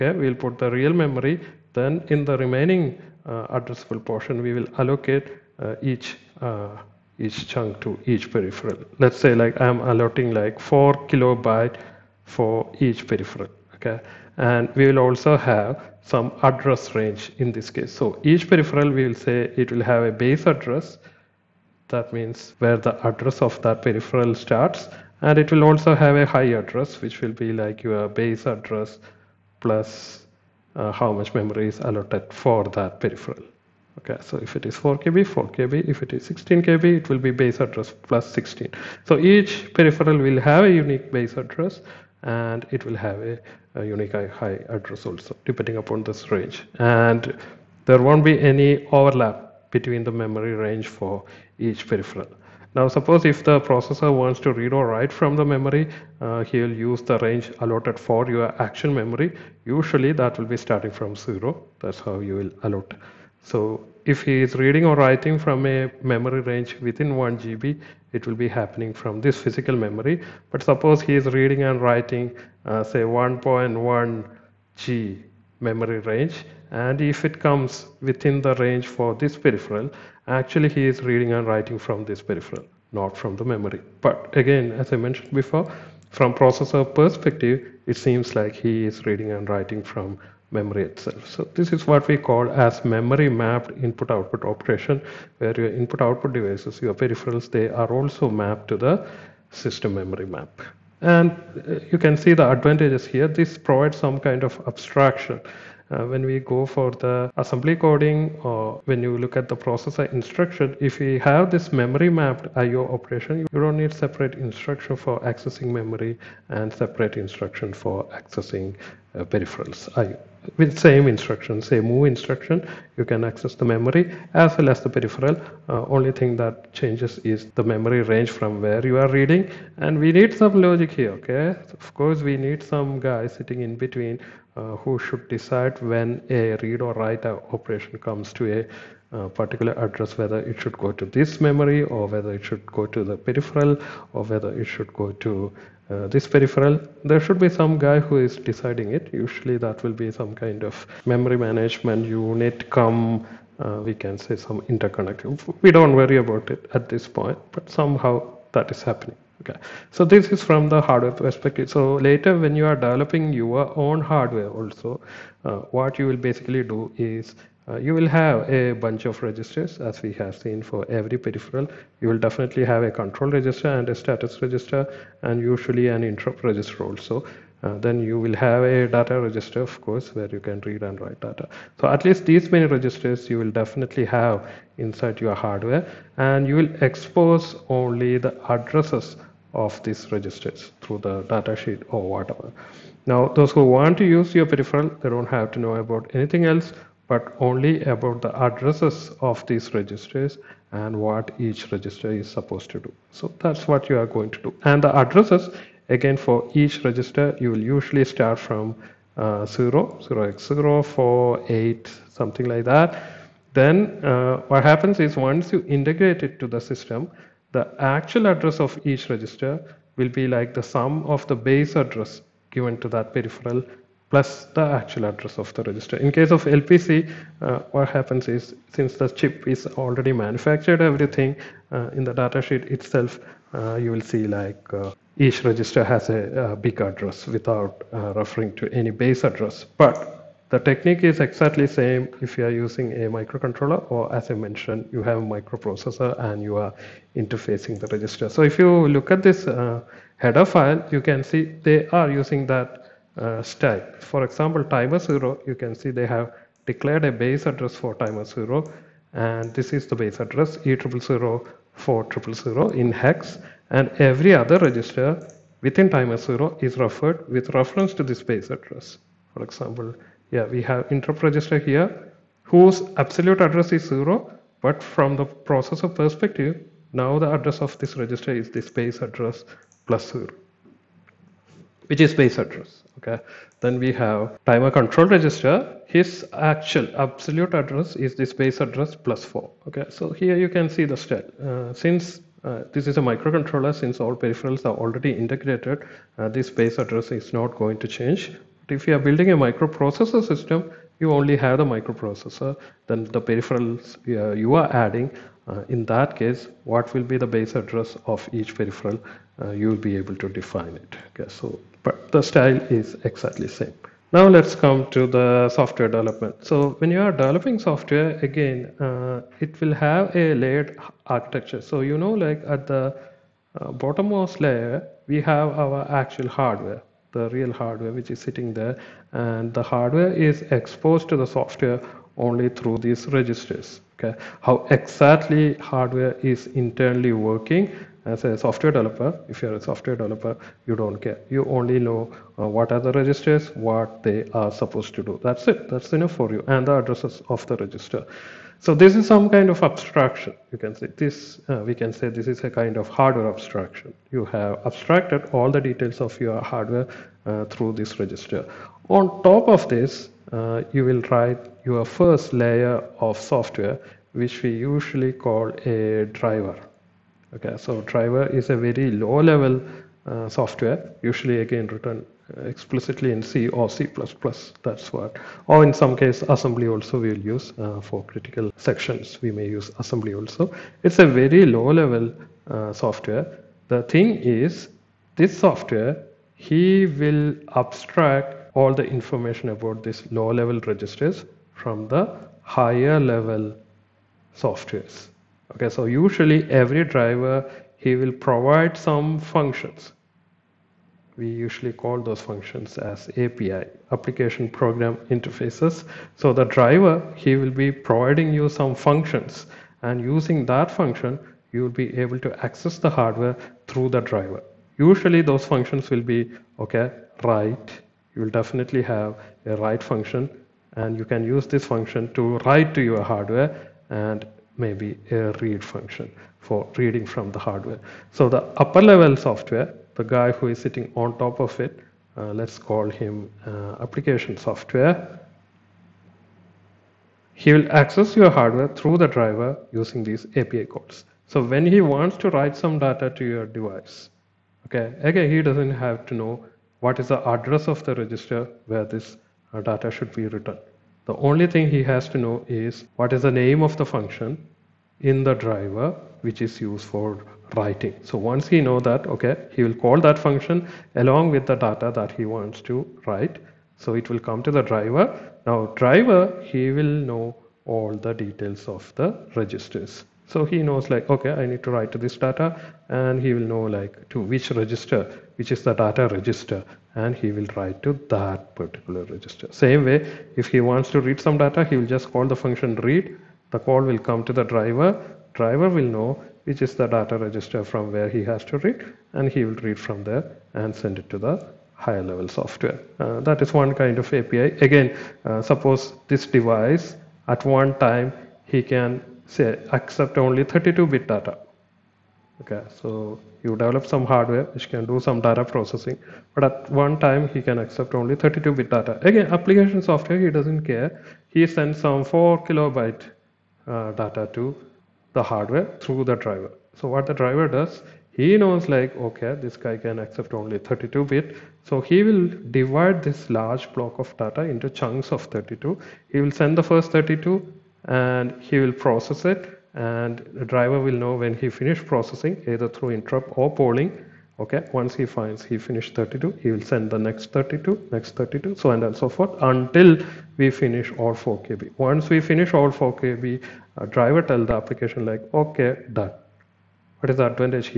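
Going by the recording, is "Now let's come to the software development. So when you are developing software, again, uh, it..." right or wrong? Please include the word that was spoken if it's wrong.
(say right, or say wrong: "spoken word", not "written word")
right.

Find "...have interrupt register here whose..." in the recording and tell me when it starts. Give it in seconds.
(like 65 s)
270 s.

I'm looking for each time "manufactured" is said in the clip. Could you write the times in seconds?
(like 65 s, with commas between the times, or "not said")
230 s.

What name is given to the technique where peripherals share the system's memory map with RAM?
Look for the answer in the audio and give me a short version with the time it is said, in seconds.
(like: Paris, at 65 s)
memory mapped input output, at 92 s.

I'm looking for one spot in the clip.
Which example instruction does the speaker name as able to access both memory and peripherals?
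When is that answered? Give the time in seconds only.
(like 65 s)
121 s.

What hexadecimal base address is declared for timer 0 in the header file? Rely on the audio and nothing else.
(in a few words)
E0004000.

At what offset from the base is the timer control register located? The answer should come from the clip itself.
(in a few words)
4.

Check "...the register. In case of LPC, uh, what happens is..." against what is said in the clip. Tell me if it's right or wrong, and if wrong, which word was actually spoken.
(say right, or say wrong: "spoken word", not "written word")
right.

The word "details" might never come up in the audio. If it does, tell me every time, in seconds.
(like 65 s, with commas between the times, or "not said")
355 s, 468 s.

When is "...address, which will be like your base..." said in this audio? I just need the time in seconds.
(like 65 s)
26 s.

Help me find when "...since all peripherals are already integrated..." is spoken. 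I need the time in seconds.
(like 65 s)
293 s.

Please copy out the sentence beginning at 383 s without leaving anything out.
The thing is, this software, he will abstract all the information about these low level registers from the higher level softwares.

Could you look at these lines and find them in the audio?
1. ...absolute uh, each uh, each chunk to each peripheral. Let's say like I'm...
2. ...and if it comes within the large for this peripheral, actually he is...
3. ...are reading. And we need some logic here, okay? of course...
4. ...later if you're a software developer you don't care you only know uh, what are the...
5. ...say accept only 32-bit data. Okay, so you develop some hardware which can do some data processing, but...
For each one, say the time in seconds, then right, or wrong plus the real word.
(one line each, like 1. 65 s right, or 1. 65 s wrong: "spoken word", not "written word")
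1. 4 s wrong: "allocate", not "absolute"
2. 76 s wrong: "range", not "large"
3. 128 s right
4. 338 s wrong: "developer", not "later"
5. 499 s right.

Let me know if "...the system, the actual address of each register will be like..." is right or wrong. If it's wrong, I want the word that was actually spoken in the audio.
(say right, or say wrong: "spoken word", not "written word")
right.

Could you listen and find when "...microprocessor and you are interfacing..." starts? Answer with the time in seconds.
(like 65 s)
245 s.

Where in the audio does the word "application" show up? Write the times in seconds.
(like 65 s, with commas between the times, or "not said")
403 s, 433 s, 509 s, 544 s.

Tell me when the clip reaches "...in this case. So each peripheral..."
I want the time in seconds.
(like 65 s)
17 s.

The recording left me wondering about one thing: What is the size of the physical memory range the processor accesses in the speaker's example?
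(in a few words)
1 GB.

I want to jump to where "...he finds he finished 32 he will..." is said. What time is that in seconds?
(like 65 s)
534 s.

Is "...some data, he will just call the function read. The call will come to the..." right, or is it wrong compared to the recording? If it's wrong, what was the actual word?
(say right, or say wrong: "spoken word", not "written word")
right.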